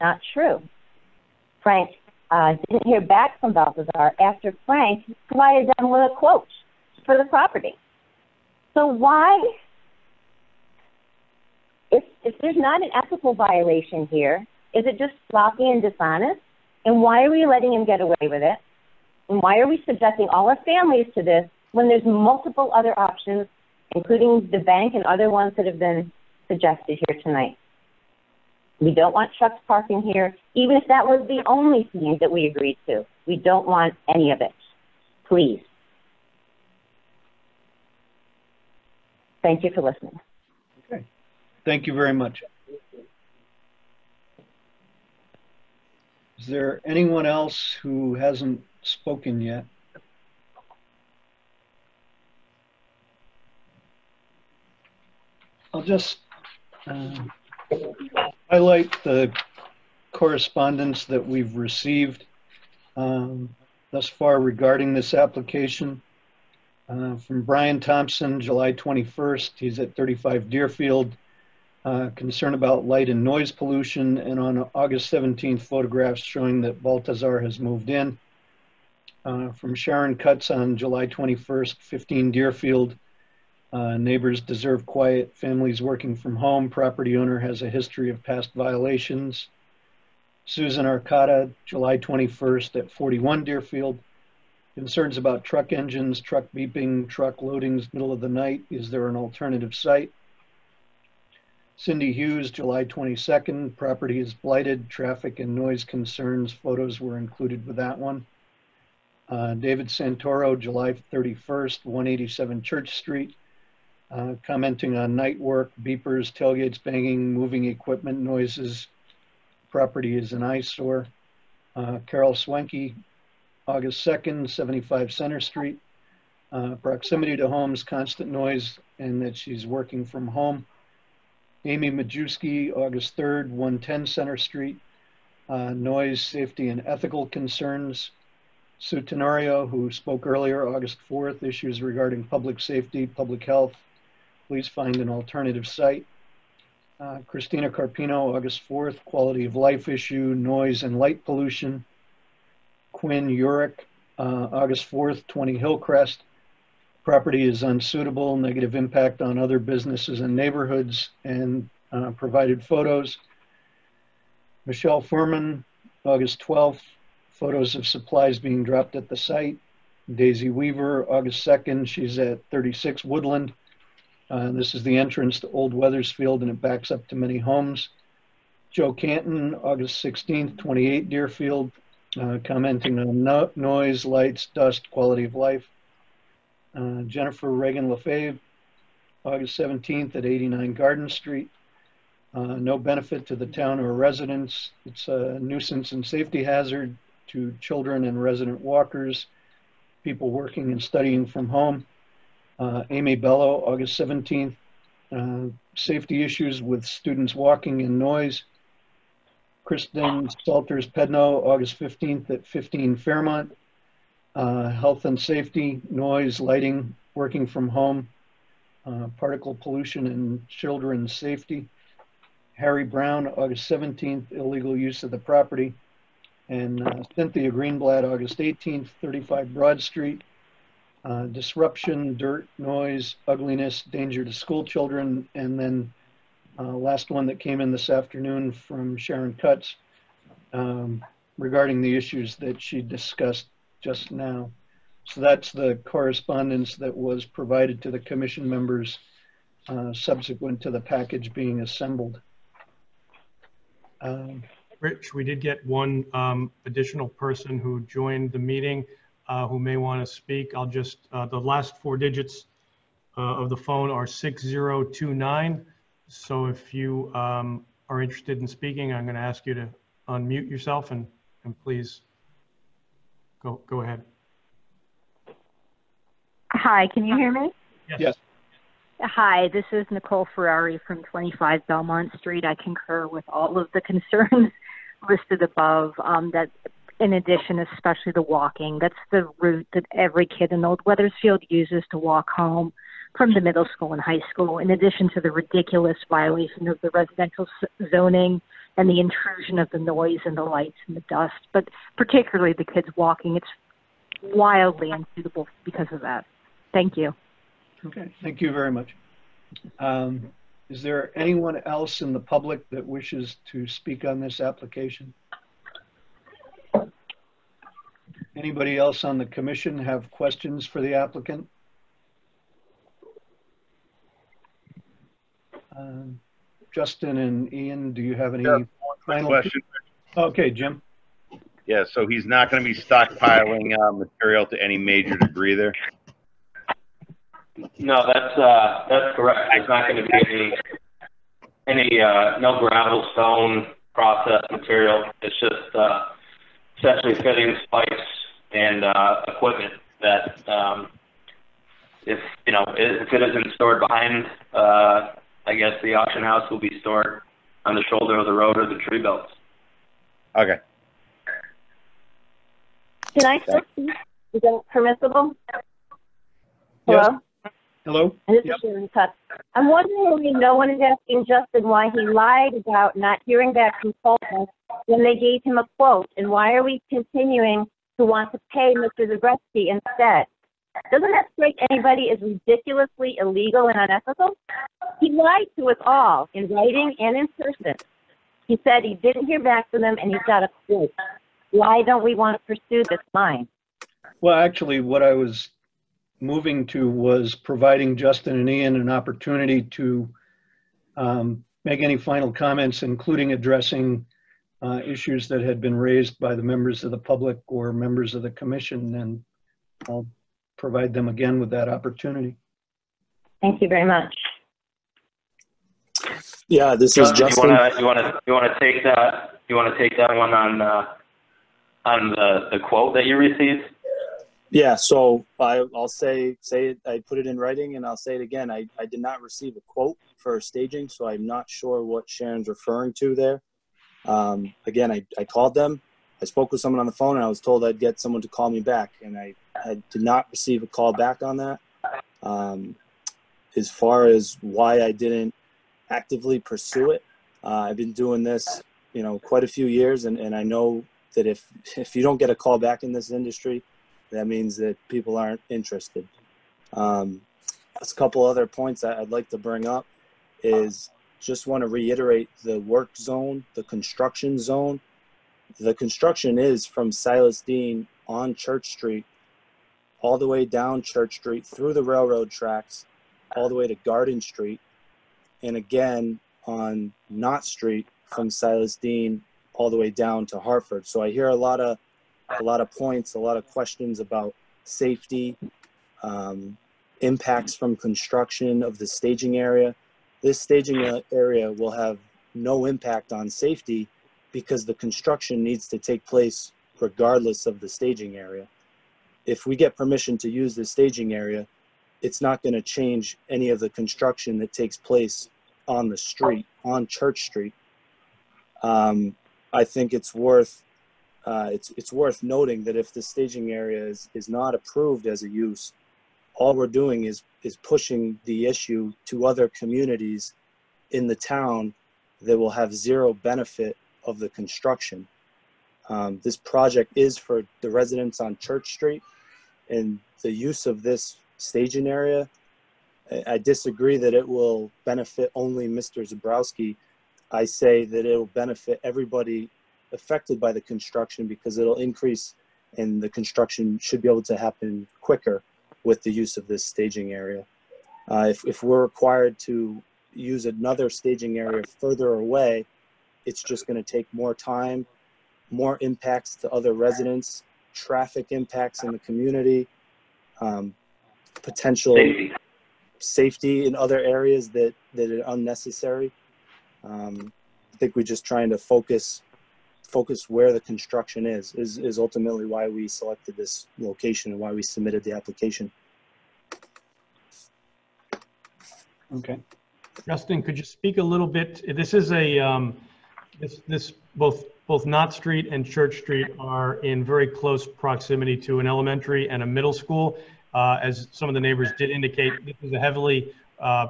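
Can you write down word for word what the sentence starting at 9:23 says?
in other areas that, that are unnecessary.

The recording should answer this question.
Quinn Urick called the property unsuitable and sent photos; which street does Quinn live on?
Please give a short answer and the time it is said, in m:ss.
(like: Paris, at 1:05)
Hillcrest, at 2:35.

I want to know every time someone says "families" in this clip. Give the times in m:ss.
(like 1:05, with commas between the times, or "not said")
0:20, 1:25.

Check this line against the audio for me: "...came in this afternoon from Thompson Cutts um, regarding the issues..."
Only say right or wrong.
wrong.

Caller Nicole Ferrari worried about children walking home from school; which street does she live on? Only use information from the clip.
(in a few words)
Belmont Street.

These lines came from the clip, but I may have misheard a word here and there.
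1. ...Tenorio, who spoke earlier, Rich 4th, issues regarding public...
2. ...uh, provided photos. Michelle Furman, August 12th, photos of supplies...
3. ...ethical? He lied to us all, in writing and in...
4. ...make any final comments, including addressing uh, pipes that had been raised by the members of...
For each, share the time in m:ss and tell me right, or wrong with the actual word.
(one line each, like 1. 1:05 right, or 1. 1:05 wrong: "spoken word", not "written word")
1. 2:19 wrong: "August", not "Rich"
2. 2:41 right
3. 6:23 wrong: "unethical", not "ethical"
4. 6:41 wrong: "issues", not "pipes".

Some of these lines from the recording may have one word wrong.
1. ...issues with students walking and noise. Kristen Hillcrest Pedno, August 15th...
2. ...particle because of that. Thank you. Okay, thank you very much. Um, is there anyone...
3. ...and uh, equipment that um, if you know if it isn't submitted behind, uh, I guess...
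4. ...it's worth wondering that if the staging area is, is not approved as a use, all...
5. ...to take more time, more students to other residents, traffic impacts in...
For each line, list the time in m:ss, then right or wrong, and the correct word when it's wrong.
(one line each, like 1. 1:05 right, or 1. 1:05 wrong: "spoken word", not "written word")
1. 3:26 wrong: "Salters", not "Hillcrest"
2. 5:04 wrong: "unsuitable", not "particle"
3. 5:48 wrong: "stored", not "submitted"
4. 8:31 wrong: "noting", not "wondering"
5. 9:13 wrong: "impacts", not "students".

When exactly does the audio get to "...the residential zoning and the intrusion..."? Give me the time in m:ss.
4:56.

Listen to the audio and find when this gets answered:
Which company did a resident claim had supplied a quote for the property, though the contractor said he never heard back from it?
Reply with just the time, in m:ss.
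6:14.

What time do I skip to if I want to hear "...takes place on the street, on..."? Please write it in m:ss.
8:24.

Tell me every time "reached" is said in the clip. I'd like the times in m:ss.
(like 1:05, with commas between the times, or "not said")
not said.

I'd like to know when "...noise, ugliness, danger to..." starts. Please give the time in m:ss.
3:52.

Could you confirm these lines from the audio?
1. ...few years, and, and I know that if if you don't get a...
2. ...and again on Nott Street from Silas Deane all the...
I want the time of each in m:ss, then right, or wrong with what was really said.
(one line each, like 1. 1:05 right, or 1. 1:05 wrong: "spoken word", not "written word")
1. 7:29 right
2. 7:55 right.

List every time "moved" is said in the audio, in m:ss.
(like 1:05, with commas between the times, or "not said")
1:17.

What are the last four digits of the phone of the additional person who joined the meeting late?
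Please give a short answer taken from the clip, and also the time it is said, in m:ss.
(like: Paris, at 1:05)
6029, at 4:24.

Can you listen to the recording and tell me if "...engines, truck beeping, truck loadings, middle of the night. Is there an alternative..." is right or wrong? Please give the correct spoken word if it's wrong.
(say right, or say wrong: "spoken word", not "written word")
right.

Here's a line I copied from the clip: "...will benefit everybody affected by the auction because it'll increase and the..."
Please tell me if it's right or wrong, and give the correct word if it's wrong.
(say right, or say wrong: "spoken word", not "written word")
wrong: "construction", not "auction".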